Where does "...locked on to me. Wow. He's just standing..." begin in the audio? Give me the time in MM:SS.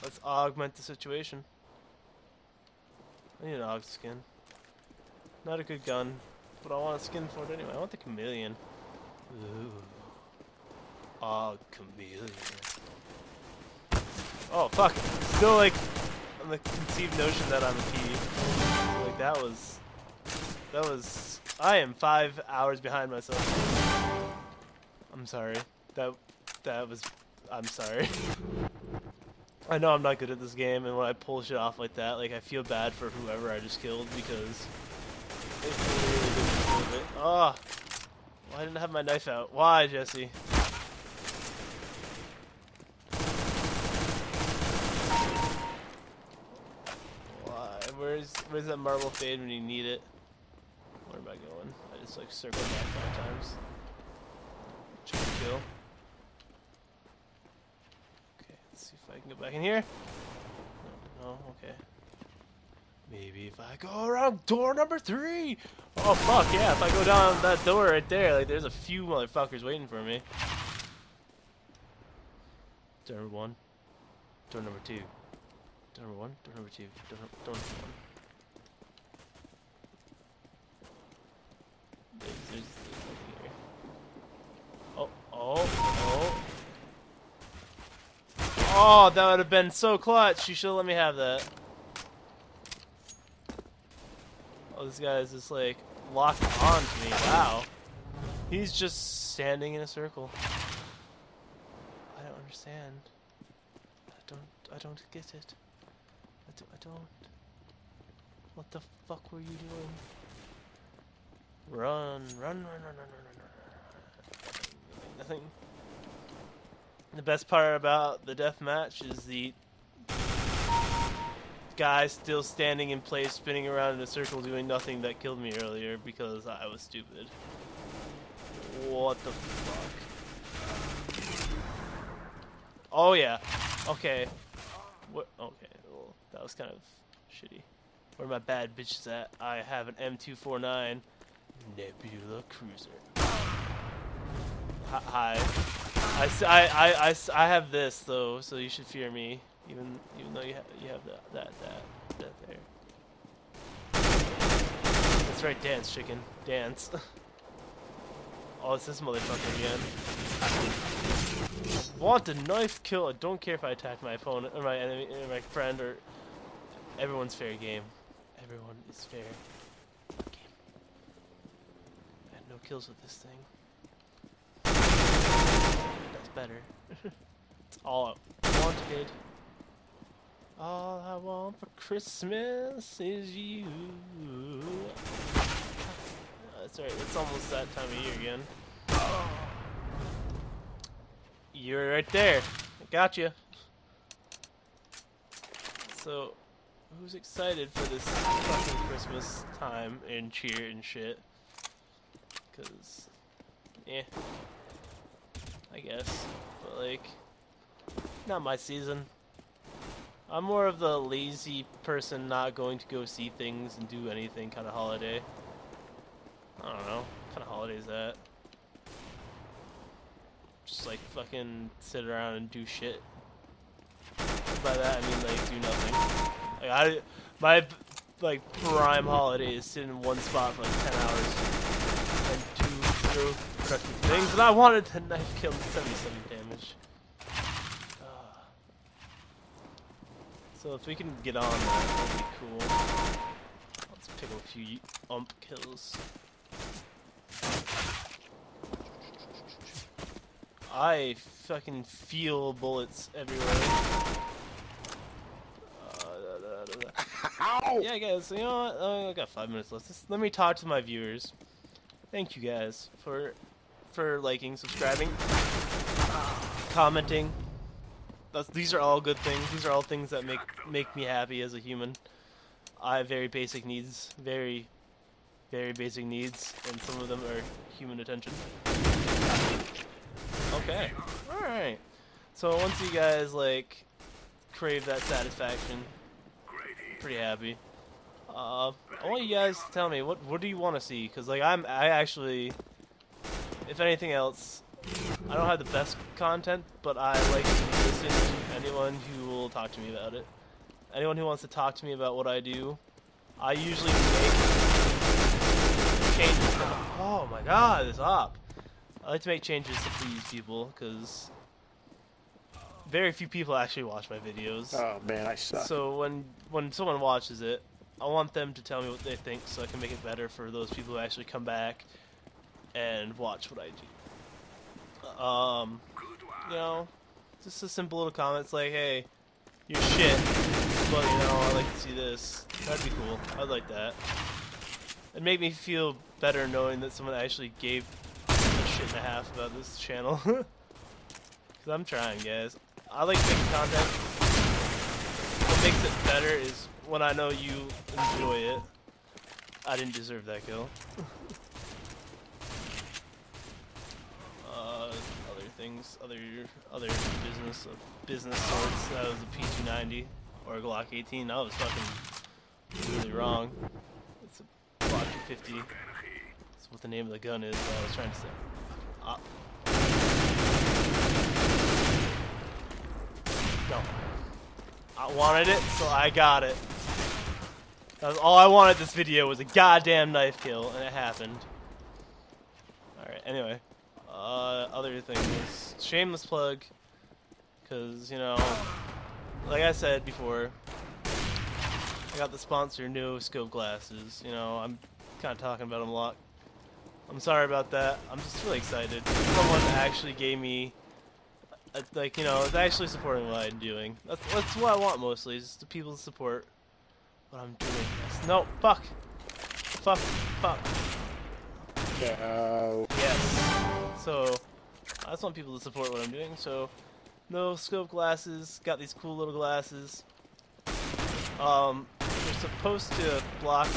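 01:36.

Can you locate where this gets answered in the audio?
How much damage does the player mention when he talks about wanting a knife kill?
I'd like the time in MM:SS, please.
03:55.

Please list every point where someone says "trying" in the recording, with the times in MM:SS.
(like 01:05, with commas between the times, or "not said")
05:41, 06:07.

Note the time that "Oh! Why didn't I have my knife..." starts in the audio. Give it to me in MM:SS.
00:37.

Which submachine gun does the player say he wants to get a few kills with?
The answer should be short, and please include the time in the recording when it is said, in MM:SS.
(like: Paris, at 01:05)
UMP, at 04:05.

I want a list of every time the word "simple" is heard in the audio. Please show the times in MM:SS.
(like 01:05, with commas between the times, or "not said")
05:27.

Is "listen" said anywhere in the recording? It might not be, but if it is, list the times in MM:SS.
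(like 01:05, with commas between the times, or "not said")
04:57.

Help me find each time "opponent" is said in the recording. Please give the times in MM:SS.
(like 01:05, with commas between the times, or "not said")
02:44.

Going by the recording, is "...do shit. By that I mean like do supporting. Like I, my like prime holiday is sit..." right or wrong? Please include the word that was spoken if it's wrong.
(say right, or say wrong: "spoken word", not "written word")
wrong: "nothing", not "supporting".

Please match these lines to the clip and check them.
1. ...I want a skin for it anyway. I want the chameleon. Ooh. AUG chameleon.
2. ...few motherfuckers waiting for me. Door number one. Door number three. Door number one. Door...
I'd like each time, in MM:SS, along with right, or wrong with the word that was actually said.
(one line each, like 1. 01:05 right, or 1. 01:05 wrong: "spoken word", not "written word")
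1. 00:06 right
2. 01:08 wrong: "two", not "three".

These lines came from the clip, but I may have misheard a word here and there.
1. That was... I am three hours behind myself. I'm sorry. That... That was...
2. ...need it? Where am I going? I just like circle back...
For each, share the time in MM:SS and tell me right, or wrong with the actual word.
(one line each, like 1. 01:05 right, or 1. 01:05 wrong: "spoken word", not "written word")
1. 00:20 wrong: "five", not "three"
2. 00:49 right.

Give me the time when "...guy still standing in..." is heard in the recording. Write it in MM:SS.
02:01.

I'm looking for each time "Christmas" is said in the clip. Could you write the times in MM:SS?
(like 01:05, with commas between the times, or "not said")
03:01, 03:18.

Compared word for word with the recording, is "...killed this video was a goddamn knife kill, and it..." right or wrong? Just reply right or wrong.
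wrong.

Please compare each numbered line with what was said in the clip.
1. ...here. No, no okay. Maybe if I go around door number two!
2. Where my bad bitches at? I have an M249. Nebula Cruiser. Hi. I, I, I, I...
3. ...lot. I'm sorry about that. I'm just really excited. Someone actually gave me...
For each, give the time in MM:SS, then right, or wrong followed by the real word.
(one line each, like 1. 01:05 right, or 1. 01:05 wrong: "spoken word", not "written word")
1. 00:59 wrong: "three", not "two"
2. 02:18 right
3. 06:35 right.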